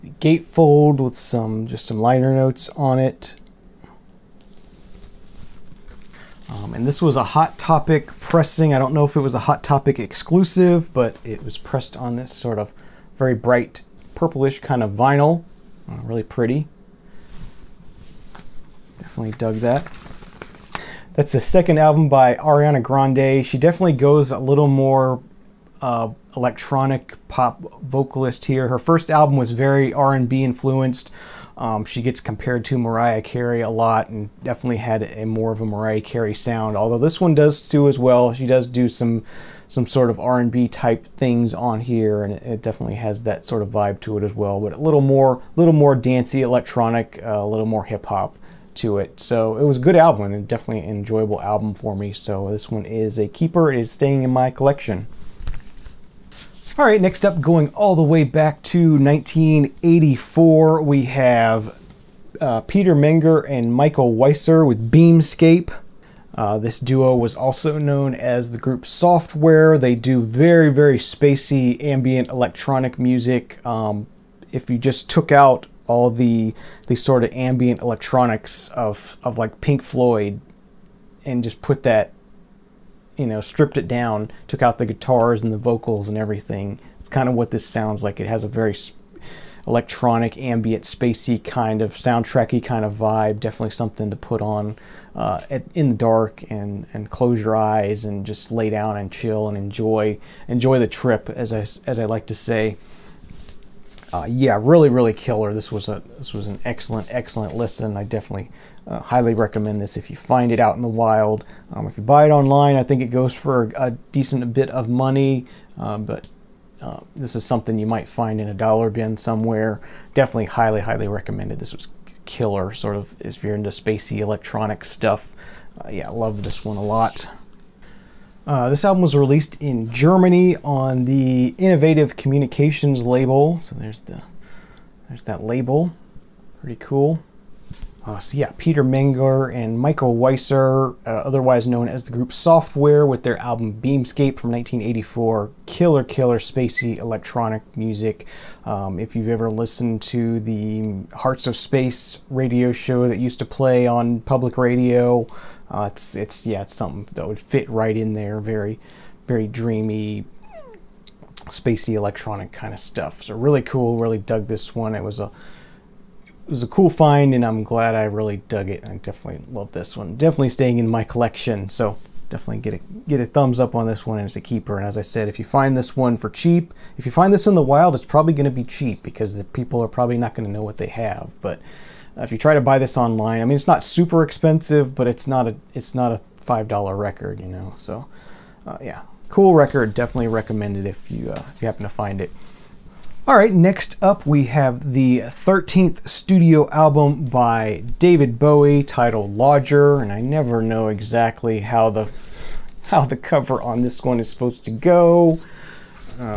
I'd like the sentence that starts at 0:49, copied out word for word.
So it was a good album and definitely an enjoyable album for me.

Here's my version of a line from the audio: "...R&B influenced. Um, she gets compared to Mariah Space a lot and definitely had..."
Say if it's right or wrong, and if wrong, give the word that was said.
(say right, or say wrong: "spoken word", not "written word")
wrong: "Carey", not "Space".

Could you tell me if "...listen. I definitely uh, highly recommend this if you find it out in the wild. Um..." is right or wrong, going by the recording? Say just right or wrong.
right.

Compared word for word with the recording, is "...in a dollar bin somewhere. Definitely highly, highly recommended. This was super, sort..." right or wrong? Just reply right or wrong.
wrong.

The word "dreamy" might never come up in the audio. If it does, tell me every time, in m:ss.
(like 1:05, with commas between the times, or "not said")
2:39.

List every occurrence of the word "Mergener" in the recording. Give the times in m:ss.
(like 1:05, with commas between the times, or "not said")
1:02, 2:18.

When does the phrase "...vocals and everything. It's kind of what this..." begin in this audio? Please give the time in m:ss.
1:25.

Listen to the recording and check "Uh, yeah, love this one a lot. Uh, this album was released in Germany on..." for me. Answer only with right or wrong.
right.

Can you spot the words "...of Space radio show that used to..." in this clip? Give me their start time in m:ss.
2:31.